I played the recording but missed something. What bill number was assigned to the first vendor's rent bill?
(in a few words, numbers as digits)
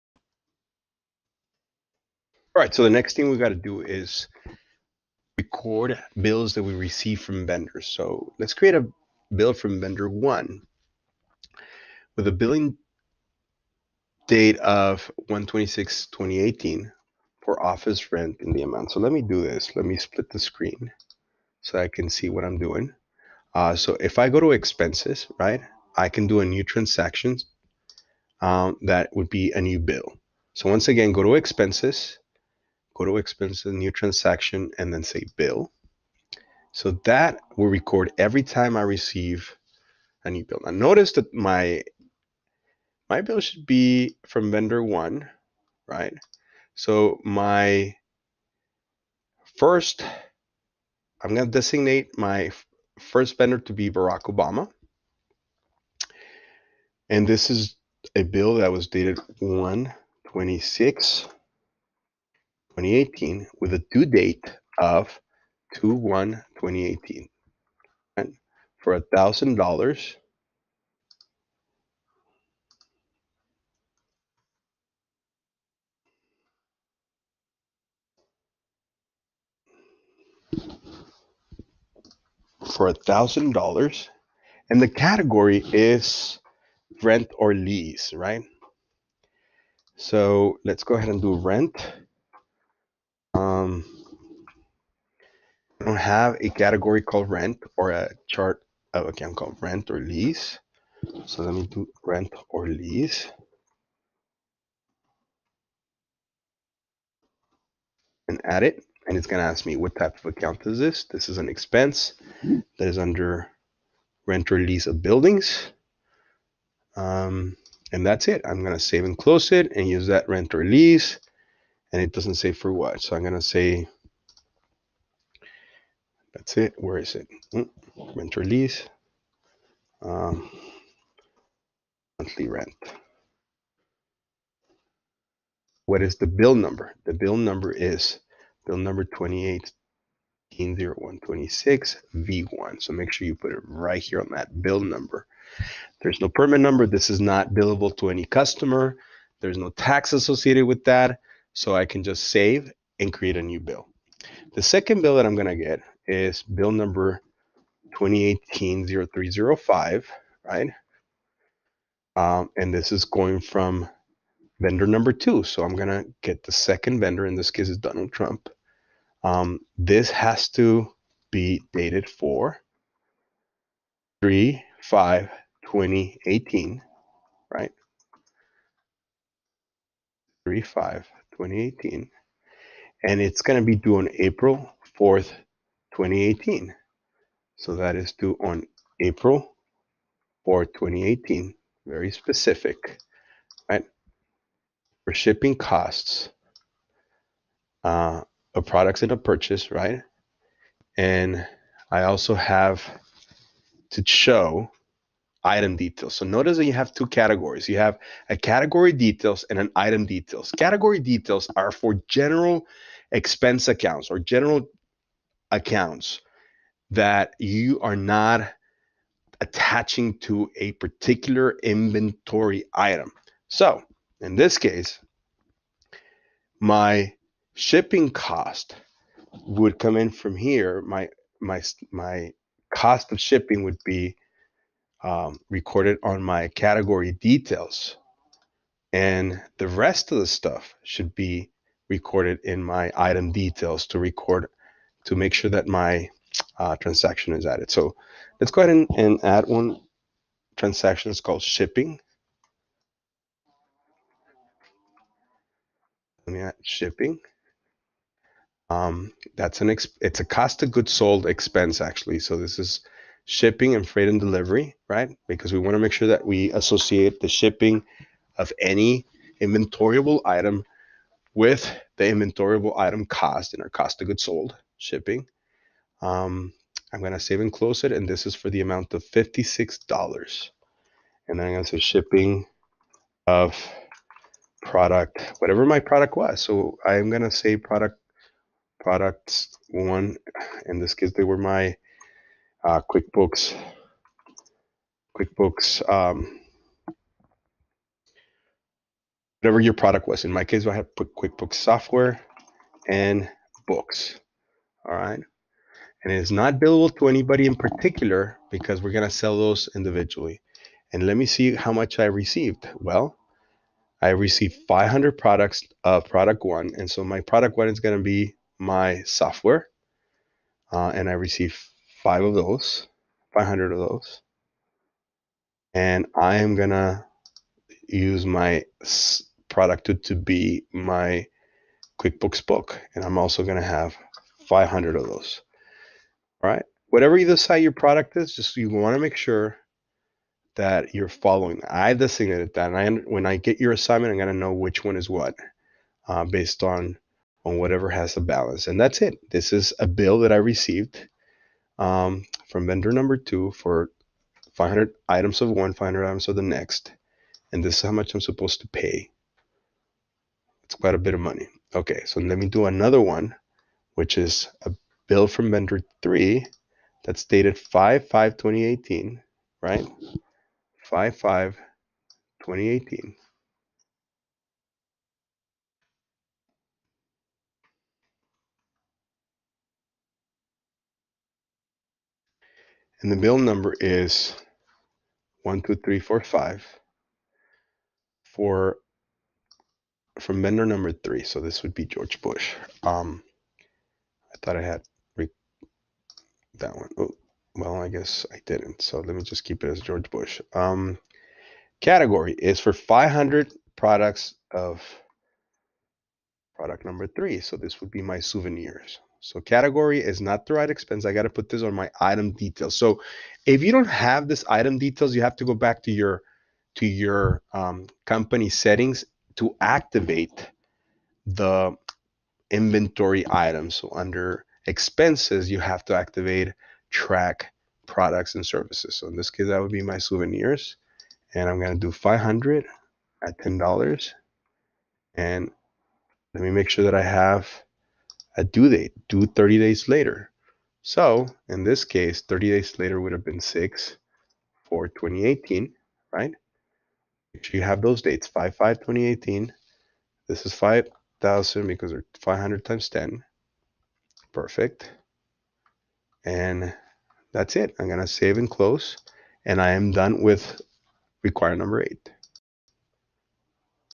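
280126 V1.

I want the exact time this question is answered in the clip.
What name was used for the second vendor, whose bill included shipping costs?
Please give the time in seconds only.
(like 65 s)
167 s.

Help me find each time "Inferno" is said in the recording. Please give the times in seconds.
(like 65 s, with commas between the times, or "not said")
not said.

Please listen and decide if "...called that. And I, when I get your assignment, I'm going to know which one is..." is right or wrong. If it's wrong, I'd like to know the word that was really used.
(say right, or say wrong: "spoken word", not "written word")
wrong: "designated", not "called".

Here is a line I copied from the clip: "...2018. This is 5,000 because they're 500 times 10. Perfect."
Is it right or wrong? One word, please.
right.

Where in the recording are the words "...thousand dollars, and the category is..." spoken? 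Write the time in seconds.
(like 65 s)
83 s.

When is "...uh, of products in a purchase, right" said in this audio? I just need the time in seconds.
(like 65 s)
197 s.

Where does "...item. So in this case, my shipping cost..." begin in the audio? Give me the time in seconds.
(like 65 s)
222 s.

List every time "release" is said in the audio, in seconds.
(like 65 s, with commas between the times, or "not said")
128 s.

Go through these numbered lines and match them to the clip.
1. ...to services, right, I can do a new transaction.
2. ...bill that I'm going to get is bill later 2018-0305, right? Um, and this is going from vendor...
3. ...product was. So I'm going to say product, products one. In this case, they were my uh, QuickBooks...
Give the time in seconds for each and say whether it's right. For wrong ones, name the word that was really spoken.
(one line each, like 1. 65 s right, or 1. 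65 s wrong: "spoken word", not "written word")
1. 24 s wrong: "expenses", not "services"
2. 155 s wrong: "number", not "later"
3. 285 s right.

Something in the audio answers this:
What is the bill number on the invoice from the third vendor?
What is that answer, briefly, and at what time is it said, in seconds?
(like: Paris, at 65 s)
12345, at 385 s.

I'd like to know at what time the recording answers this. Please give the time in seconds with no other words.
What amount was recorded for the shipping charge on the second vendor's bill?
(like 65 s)
279 s.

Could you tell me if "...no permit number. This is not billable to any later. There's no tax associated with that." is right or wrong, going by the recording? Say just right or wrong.
wrong.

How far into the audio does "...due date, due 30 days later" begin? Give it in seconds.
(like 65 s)
438 s.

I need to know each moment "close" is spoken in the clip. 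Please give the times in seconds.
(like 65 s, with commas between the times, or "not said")
119 s, 277 s, 458 s.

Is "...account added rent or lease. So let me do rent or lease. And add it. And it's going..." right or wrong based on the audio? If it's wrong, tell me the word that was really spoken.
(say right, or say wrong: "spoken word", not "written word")
wrong: "called", not "added".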